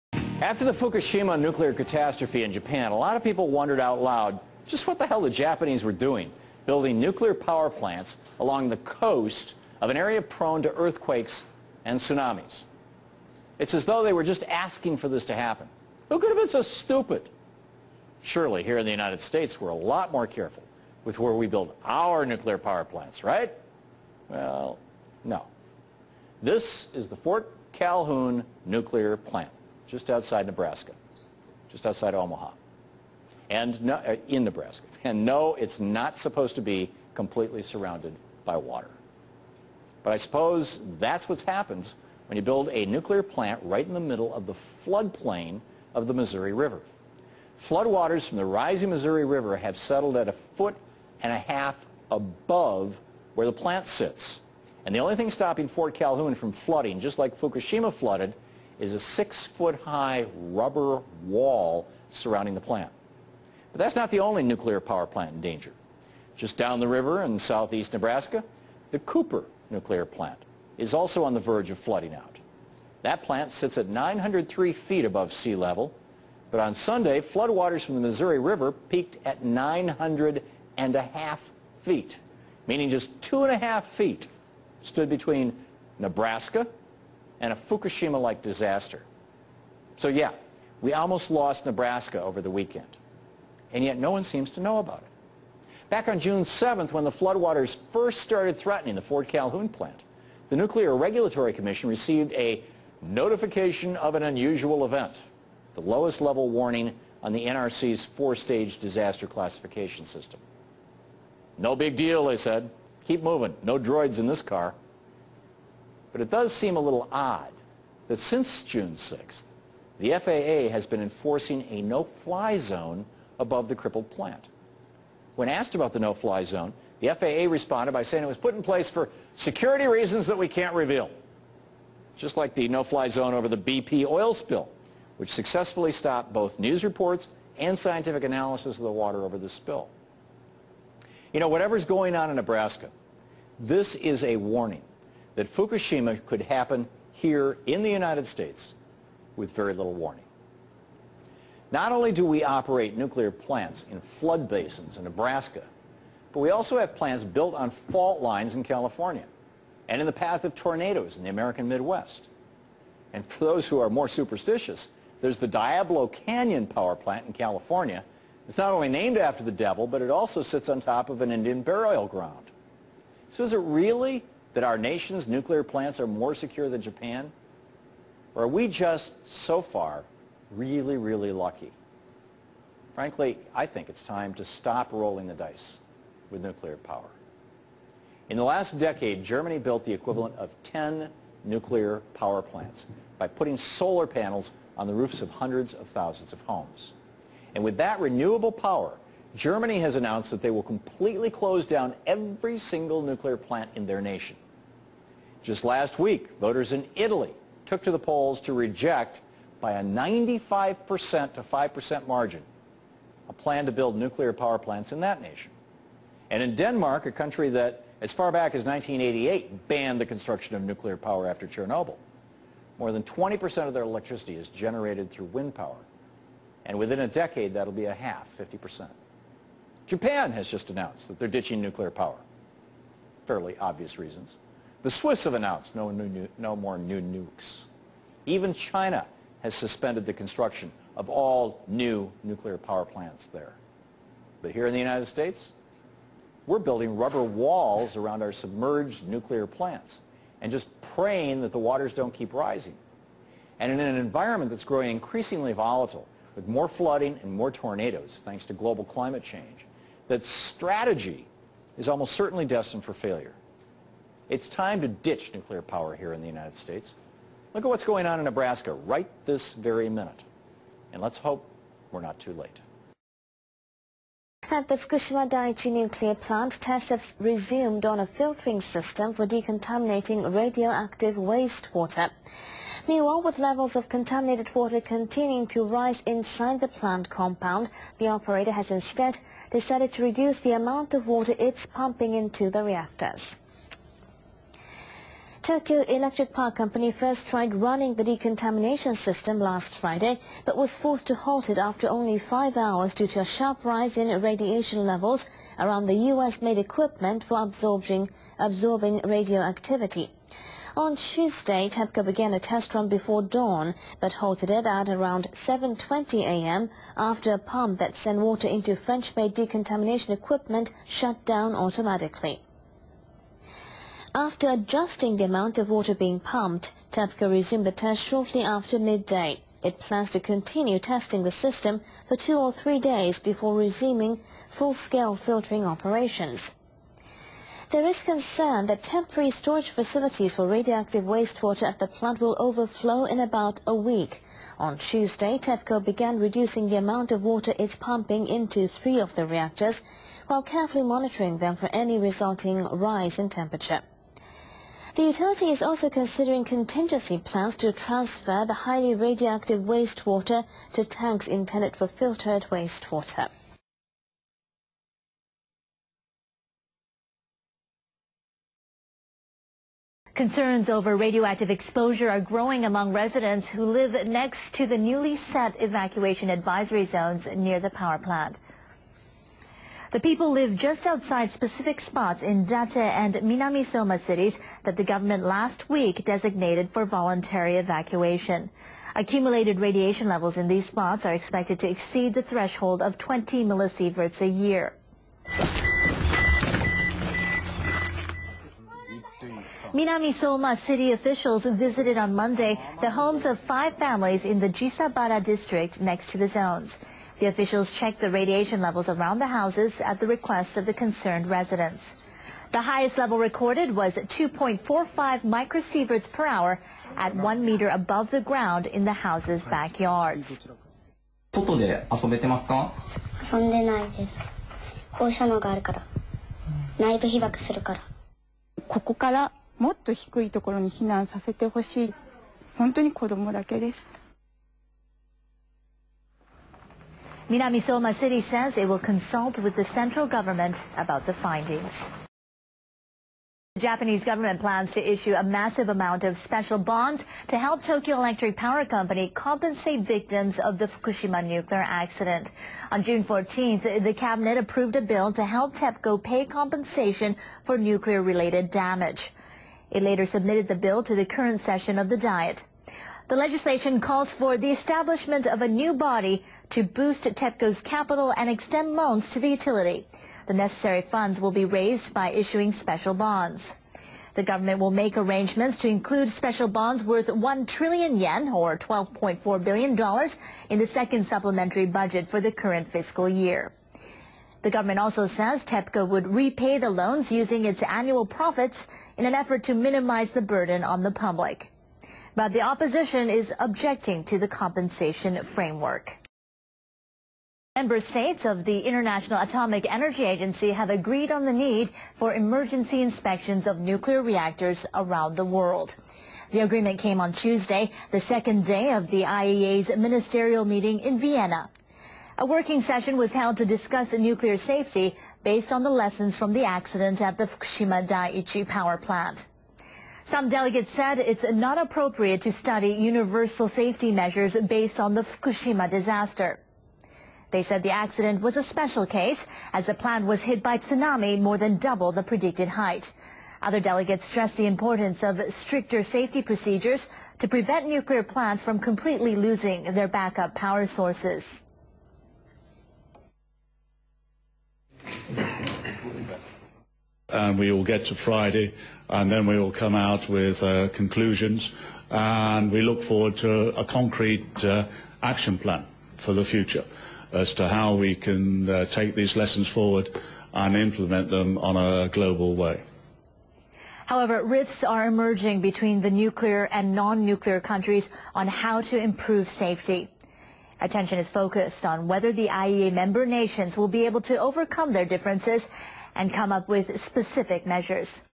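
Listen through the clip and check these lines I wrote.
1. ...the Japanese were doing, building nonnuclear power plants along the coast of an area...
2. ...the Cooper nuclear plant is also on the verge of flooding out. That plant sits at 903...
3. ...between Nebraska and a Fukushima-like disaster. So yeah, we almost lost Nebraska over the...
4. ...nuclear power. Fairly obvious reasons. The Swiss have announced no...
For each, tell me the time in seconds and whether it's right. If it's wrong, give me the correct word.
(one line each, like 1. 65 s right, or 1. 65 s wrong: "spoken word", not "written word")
1. 5 s wrong: "nuclear", not "nonnuclear"
2. 68 s right
3. 85 s right
4. 231 s right.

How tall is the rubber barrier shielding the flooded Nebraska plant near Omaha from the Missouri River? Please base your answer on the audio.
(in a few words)
6 feet.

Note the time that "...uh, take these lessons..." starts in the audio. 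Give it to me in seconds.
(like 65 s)
558 s.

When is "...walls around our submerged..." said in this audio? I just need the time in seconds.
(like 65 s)
247 s.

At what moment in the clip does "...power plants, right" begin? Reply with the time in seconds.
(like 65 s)
22 s.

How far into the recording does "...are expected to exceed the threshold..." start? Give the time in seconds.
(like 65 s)
391 s.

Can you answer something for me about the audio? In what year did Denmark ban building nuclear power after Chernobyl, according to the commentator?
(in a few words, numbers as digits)
1988.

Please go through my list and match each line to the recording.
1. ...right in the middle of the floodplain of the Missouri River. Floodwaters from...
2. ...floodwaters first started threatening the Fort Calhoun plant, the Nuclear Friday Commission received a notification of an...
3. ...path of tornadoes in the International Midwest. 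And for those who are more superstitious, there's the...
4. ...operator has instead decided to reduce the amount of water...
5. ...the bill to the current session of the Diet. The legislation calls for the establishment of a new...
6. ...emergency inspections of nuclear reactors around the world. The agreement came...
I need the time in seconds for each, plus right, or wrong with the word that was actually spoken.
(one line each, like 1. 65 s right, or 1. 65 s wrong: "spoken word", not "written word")
1. 43 s right
2. 97 s wrong: "Regulatory", not "Friday"
3. 160 s wrong: "American", not "International"
4. 288 s right
5. 460 s right
6. 502 s right.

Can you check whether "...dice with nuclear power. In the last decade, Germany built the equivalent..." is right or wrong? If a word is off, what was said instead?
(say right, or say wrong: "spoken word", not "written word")
right.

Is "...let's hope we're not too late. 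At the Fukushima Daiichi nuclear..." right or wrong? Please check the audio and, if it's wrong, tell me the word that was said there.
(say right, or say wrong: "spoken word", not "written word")
right.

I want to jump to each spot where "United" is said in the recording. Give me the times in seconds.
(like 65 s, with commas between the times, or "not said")
18 s, 147 s, 244 s, 266 s.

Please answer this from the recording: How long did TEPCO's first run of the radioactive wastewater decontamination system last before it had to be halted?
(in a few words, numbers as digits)
5 hours.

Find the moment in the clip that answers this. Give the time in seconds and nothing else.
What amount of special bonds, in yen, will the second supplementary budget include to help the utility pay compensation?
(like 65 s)
477 s.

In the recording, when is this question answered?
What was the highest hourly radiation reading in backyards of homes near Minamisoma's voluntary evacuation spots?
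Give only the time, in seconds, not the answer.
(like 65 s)
413 s.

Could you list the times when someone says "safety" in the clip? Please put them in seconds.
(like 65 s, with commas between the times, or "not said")
514 s, 523 s, 535 s, 569 s.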